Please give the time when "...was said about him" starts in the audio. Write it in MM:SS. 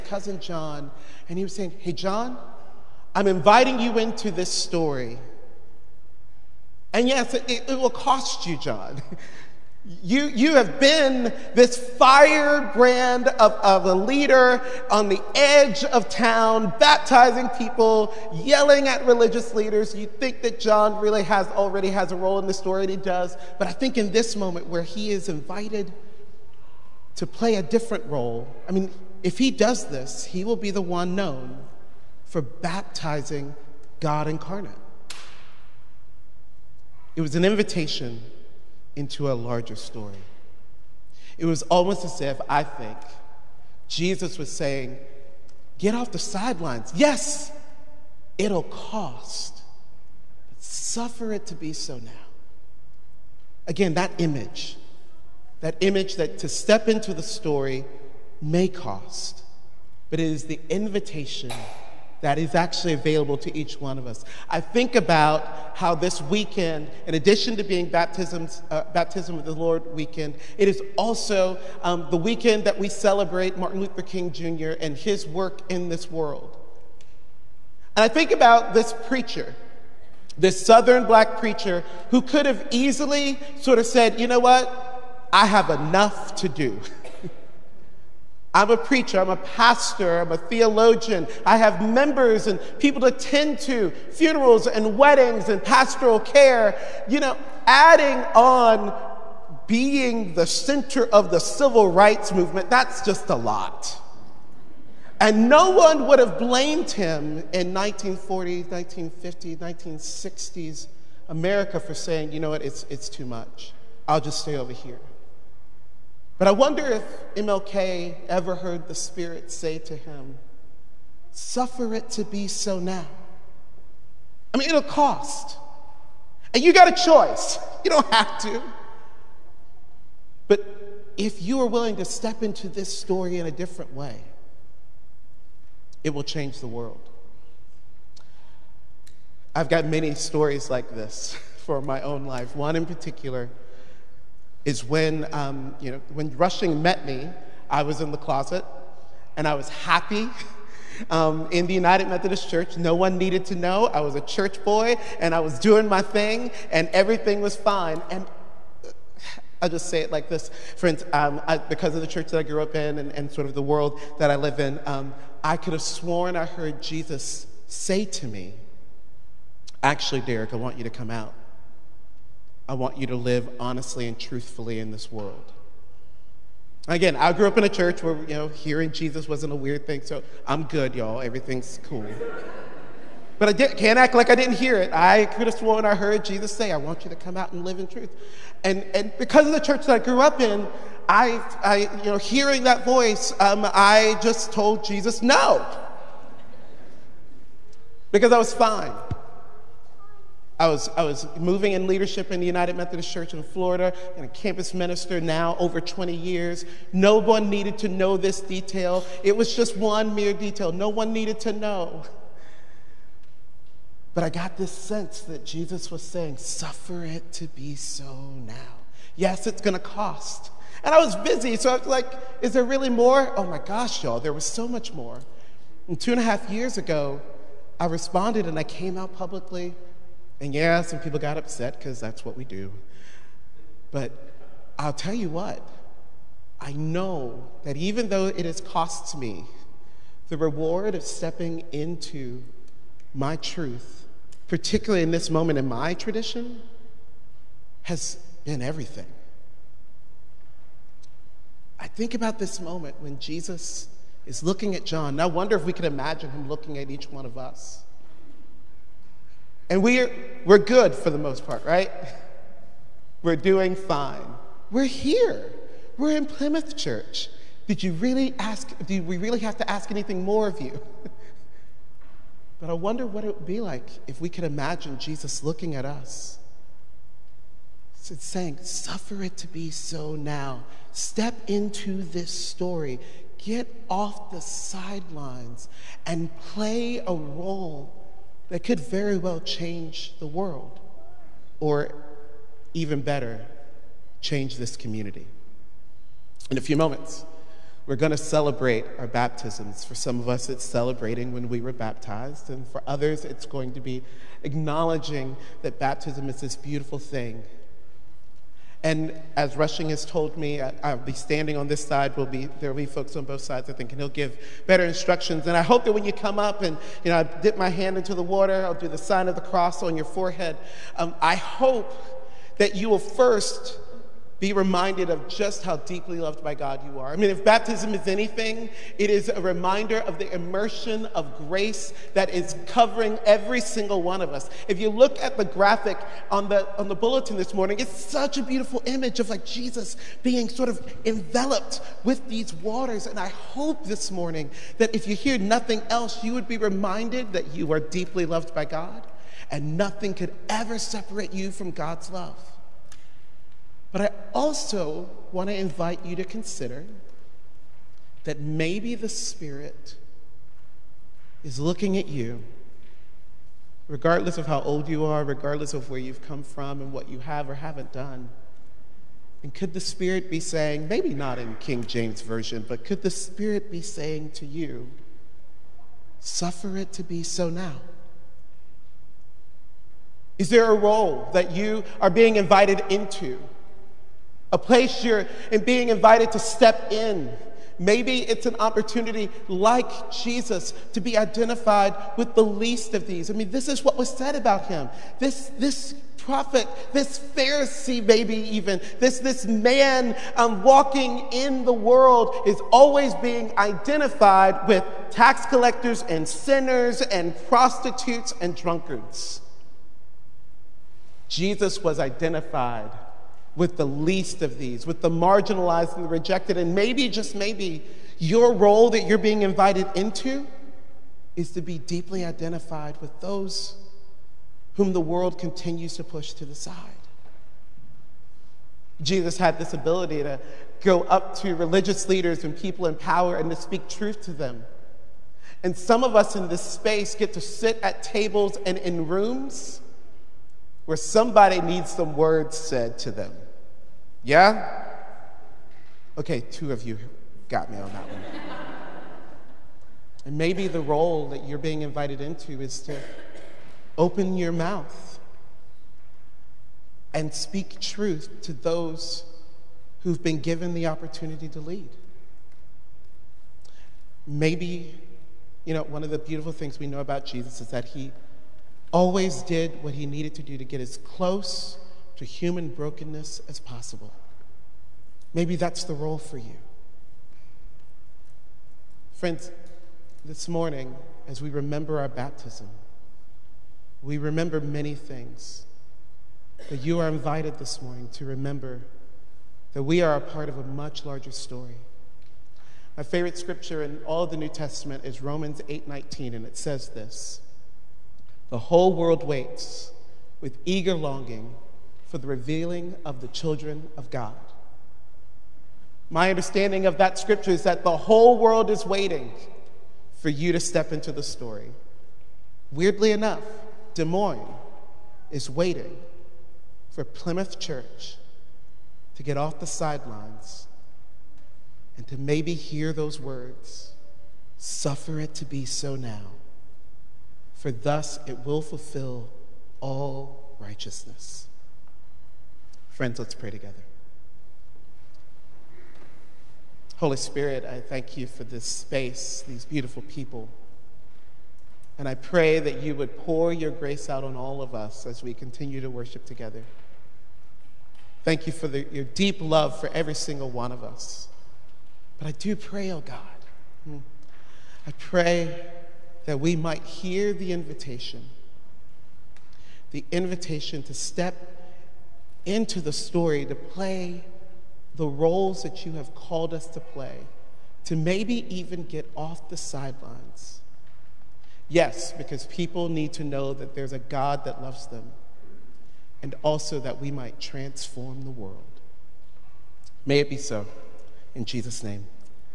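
06:33.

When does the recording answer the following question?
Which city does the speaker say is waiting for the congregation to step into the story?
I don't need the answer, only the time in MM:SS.
08:33.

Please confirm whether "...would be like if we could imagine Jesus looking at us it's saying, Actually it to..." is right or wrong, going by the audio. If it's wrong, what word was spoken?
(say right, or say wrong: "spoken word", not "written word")
wrong: "Suffer", not "Actually".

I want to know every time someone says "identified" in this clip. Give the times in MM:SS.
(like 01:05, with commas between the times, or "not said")
06:31, 06:43, 06:51, 07:02.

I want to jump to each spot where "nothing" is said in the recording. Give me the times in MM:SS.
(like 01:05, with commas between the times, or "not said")
05:45, 05:49.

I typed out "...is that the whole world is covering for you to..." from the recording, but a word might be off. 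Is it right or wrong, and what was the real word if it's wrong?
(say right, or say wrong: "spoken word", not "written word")
wrong: "waiting", not "covering".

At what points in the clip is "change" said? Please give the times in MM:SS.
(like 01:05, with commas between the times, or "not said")
02:16, 04:49, 04:54.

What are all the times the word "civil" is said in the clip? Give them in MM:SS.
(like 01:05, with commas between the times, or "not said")
01:41.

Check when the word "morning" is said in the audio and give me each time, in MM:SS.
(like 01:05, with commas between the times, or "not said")
05:37, 05:44, 08:00, 08:07.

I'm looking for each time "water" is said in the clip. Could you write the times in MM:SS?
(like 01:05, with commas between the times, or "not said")
05:18, 05:42.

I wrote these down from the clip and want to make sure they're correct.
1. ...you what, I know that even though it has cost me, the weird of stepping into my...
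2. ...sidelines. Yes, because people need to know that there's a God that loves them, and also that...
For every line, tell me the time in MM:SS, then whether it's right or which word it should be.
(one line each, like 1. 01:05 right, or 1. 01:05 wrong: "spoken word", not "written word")
1. 03:55 wrong: "reward", not "weird"
2. 09:29 right.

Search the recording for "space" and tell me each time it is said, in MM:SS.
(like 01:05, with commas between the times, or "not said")
07:16, 08:58.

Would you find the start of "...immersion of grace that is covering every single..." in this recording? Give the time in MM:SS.
05:30.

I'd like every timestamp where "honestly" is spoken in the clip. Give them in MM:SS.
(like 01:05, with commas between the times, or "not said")
02:53.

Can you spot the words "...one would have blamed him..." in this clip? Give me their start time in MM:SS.
01:45.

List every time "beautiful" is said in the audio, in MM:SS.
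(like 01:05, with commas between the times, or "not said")
05:06, 05:38, 07:46, 08:59.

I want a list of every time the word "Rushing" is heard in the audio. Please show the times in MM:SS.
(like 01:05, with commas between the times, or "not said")
02:26, 05:09.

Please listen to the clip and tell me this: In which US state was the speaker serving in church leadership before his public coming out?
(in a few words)
Florida.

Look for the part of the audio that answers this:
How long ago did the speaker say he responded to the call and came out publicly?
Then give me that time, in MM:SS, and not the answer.
03:45.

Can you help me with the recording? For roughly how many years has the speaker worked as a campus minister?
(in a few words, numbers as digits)
Over 20 years.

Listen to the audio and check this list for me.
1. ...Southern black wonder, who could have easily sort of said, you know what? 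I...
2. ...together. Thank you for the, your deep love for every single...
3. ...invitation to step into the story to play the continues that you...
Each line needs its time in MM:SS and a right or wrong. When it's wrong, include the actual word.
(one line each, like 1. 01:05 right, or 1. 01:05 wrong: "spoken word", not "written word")
1. 01:20 wrong: "preacher", not "wonder"
2. 09:06 right
3. 09:20 wrong: "roles", not "continues".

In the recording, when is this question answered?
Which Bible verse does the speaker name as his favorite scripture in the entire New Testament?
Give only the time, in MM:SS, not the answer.
08:15.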